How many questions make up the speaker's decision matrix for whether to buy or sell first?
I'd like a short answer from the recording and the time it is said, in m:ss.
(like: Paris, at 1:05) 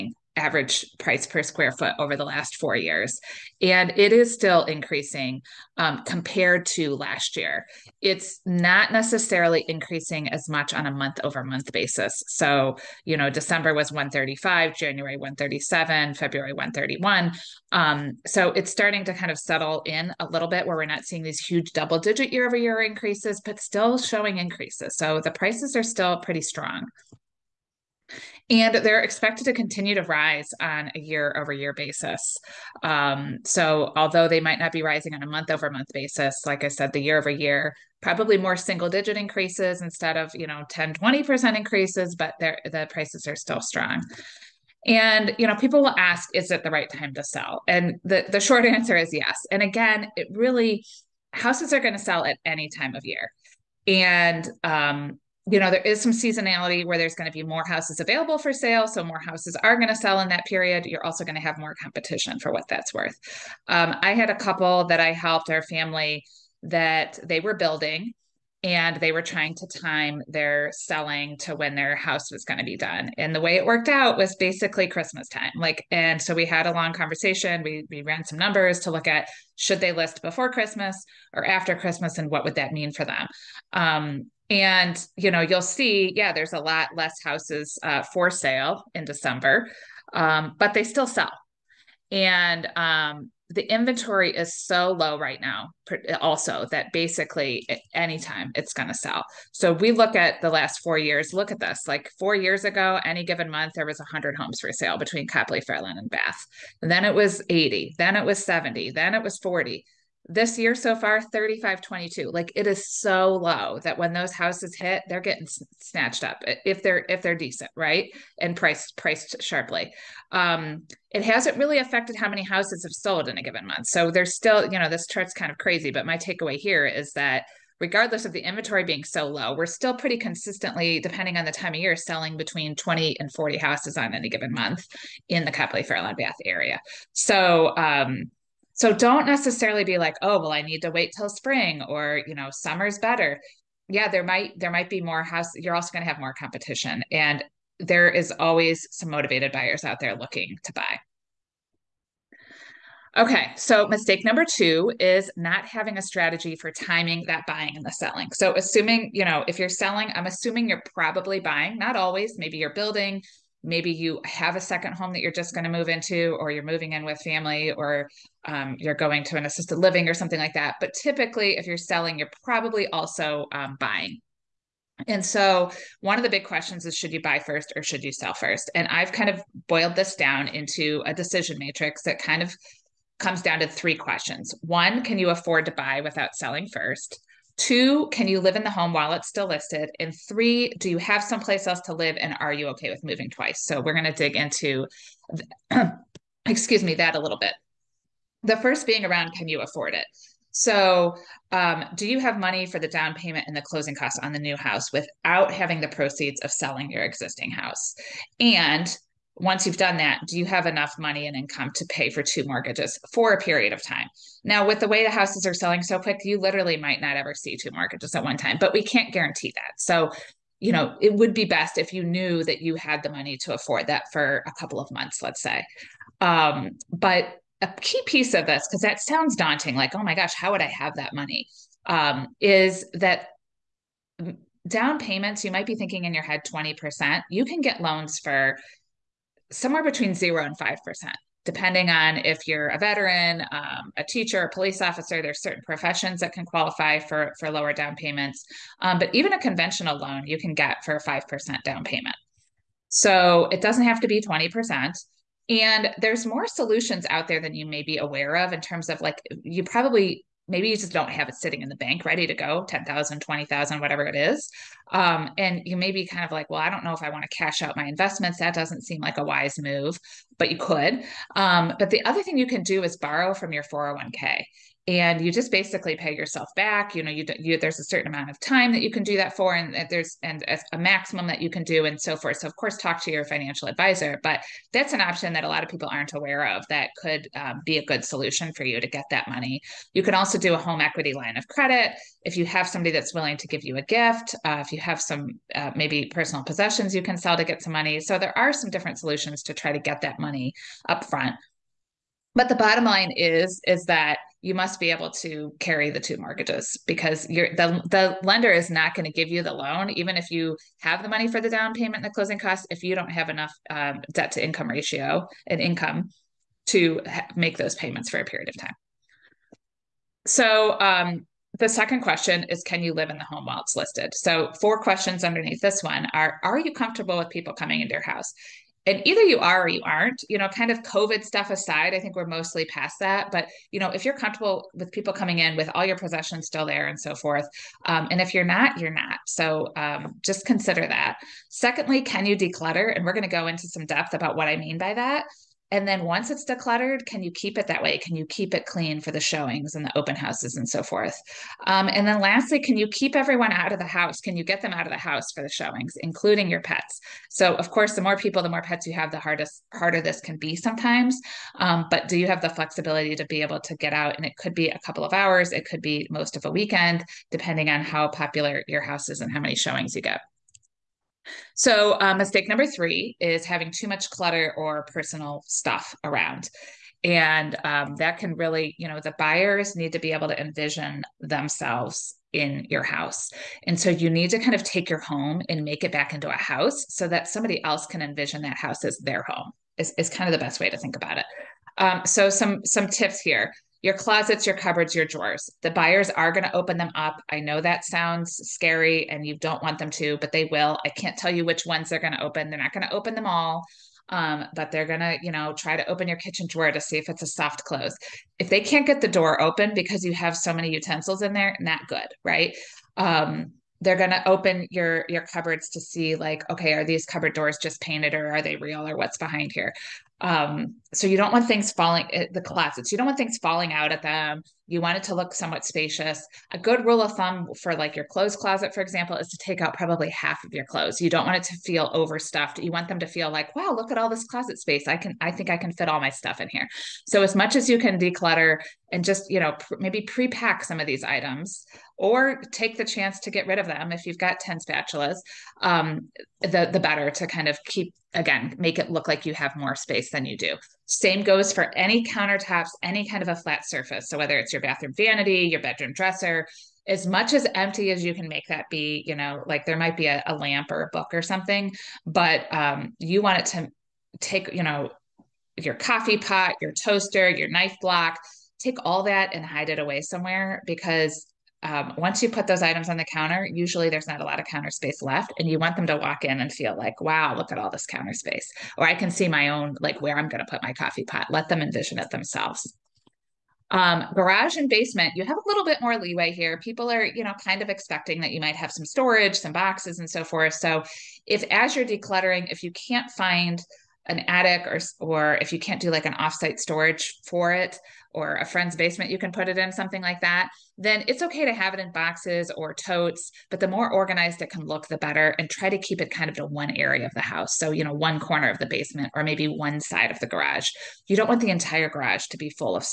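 3, at 3:03.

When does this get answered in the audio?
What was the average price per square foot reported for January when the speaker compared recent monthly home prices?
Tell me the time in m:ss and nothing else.
0:14.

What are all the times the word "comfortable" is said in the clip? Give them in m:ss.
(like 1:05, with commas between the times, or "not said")
5:26, 5:34.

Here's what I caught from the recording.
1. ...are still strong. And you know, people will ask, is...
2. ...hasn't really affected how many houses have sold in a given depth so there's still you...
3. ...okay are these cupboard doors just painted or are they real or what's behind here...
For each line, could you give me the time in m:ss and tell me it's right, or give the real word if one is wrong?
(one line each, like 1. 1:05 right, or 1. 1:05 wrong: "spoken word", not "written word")
1. 0:43 right
2. 2:01 wrong: "month", not "depth"
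3. 6:56 right.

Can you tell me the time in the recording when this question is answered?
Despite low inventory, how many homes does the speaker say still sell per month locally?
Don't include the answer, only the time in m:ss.
2:12.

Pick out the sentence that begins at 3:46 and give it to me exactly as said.
Um, but a key piece of this, because that sounds daunting, like, oh my gosh, how would I have that money?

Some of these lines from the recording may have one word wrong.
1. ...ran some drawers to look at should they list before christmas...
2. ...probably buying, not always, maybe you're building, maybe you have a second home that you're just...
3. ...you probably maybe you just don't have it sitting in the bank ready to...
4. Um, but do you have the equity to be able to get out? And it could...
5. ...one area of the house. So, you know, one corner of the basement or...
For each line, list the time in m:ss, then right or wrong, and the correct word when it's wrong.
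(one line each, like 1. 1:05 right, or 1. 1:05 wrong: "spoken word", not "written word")
1. 1:18 wrong: "numbers", not "drawers"
2. 2:40 right
3. 4:19 right
4. 6:01 wrong: "flexibility", not "equity"
5. 8:26 right.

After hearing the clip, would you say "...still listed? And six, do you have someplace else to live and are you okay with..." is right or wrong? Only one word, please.
wrong.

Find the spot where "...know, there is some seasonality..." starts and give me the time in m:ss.
0:55.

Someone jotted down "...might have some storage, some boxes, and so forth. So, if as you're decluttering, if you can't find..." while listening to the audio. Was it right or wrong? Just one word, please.
right.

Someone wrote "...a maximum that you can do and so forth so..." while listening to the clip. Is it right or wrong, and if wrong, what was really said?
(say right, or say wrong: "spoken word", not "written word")
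right.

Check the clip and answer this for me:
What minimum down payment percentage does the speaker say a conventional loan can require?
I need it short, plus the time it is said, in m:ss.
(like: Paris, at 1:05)
5%, at 4:11.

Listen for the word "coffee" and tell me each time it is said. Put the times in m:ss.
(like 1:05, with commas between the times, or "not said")
7:45, 8:00.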